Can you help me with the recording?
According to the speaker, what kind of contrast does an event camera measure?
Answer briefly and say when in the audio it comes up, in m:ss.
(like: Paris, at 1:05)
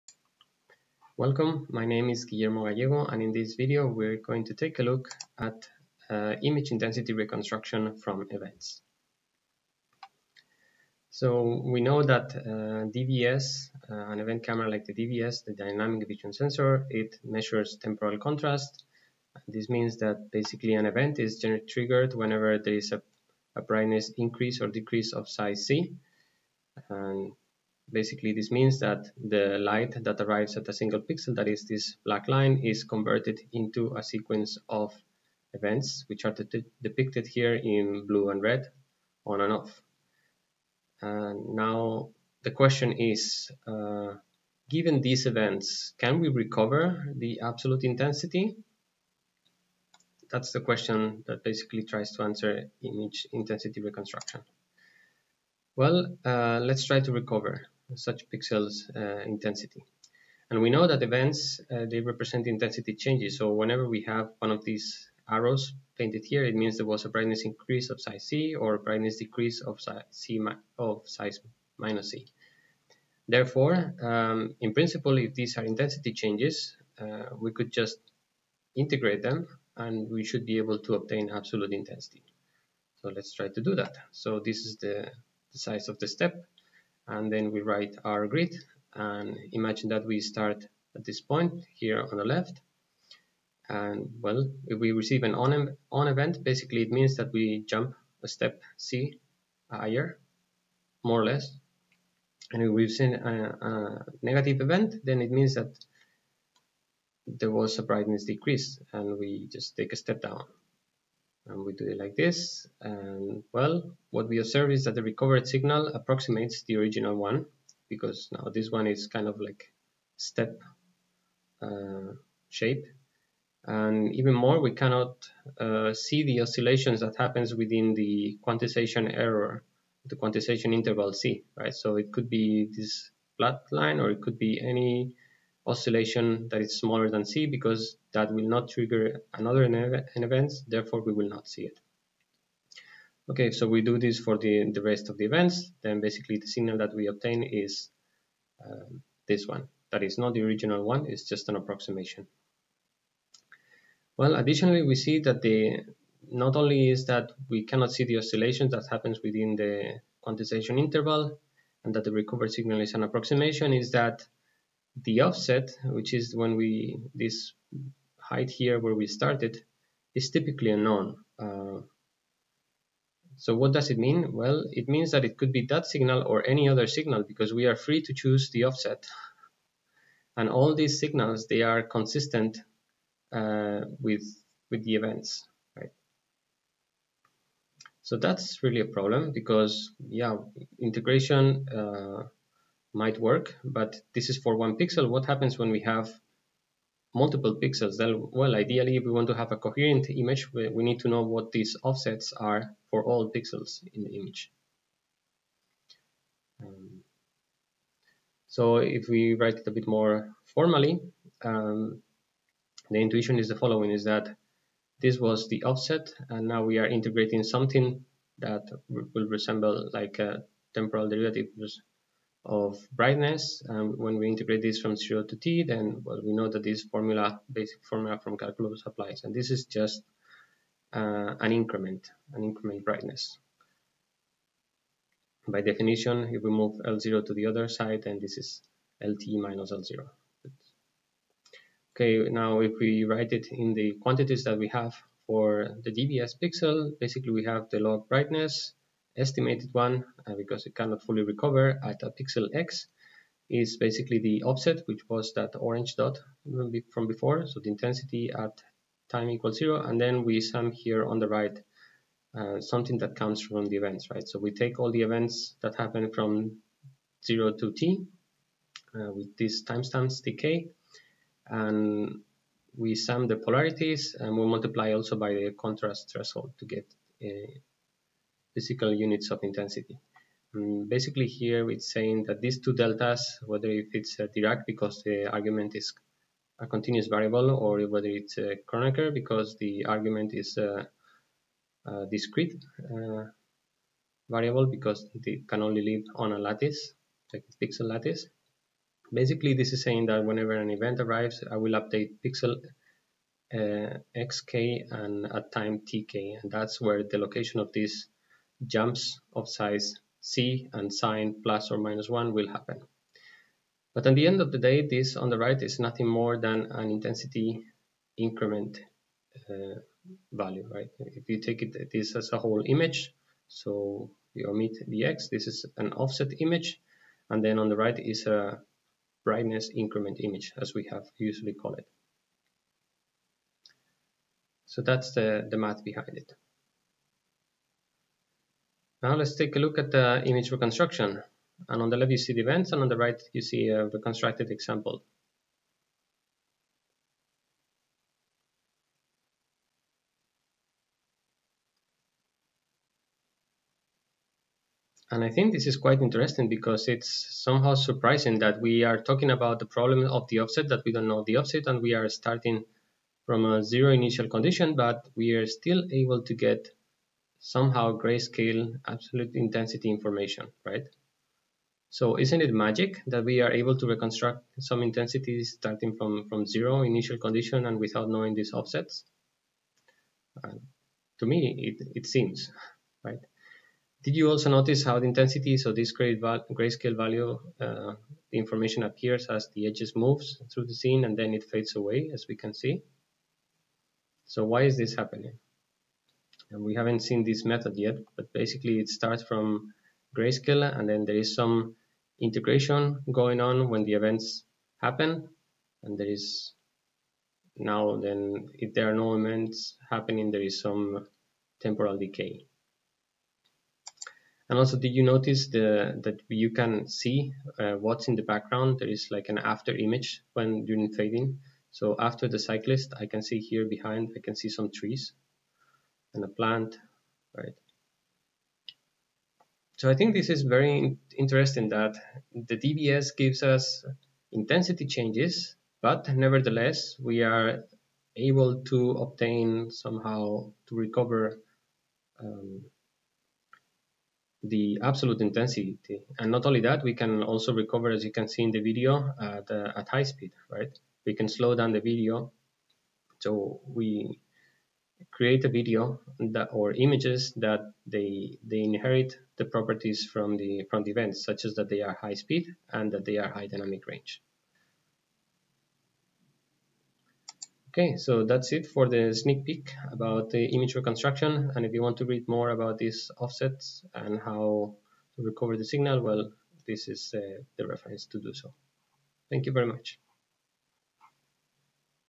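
temporal contrast, at 0:17.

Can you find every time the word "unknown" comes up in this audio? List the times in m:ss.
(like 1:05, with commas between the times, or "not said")
2:50.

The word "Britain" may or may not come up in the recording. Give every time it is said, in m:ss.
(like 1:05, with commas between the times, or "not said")
not said.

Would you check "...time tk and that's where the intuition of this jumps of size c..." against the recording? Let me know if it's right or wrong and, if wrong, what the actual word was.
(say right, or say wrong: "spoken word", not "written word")
wrong: "location", not "intuition".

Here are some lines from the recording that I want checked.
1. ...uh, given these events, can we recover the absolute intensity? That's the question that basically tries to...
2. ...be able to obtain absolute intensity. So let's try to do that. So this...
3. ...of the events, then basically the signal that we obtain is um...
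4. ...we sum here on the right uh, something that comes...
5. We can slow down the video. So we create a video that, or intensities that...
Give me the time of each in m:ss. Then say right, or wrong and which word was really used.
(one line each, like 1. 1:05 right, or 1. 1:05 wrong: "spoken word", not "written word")
1. 0:43 right
2. 1:20 right
3. 2:25 right
4. 4:20 right
5. 7:31 wrong: "images", not "intensities".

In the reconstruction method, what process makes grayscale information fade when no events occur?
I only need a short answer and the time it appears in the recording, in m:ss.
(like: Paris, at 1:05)
temporal decay, at 6:51.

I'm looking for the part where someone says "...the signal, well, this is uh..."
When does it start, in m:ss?
7:55.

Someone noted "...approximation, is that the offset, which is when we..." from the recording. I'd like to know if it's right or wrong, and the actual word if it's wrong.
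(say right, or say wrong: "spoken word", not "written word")
right.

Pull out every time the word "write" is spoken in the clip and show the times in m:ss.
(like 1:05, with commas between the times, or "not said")
1:27, 3:29, 4:03.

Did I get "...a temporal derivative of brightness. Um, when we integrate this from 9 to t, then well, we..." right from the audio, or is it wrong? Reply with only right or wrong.
wrong.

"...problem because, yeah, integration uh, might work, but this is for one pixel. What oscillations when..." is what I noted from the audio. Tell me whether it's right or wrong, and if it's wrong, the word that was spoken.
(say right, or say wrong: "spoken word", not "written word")
wrong: "happens", not "oscillations".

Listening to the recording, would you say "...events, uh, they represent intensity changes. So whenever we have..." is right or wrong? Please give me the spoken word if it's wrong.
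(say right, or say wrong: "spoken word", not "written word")
right.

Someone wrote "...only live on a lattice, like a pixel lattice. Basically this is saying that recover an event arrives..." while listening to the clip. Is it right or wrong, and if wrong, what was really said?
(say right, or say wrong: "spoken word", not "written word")
wrong: "whenever", not "recover".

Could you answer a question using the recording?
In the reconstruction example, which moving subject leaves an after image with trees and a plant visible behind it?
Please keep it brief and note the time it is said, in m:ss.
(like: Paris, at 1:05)
cyclist, at 7:02.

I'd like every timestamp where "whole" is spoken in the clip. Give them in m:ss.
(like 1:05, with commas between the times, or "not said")
5:22.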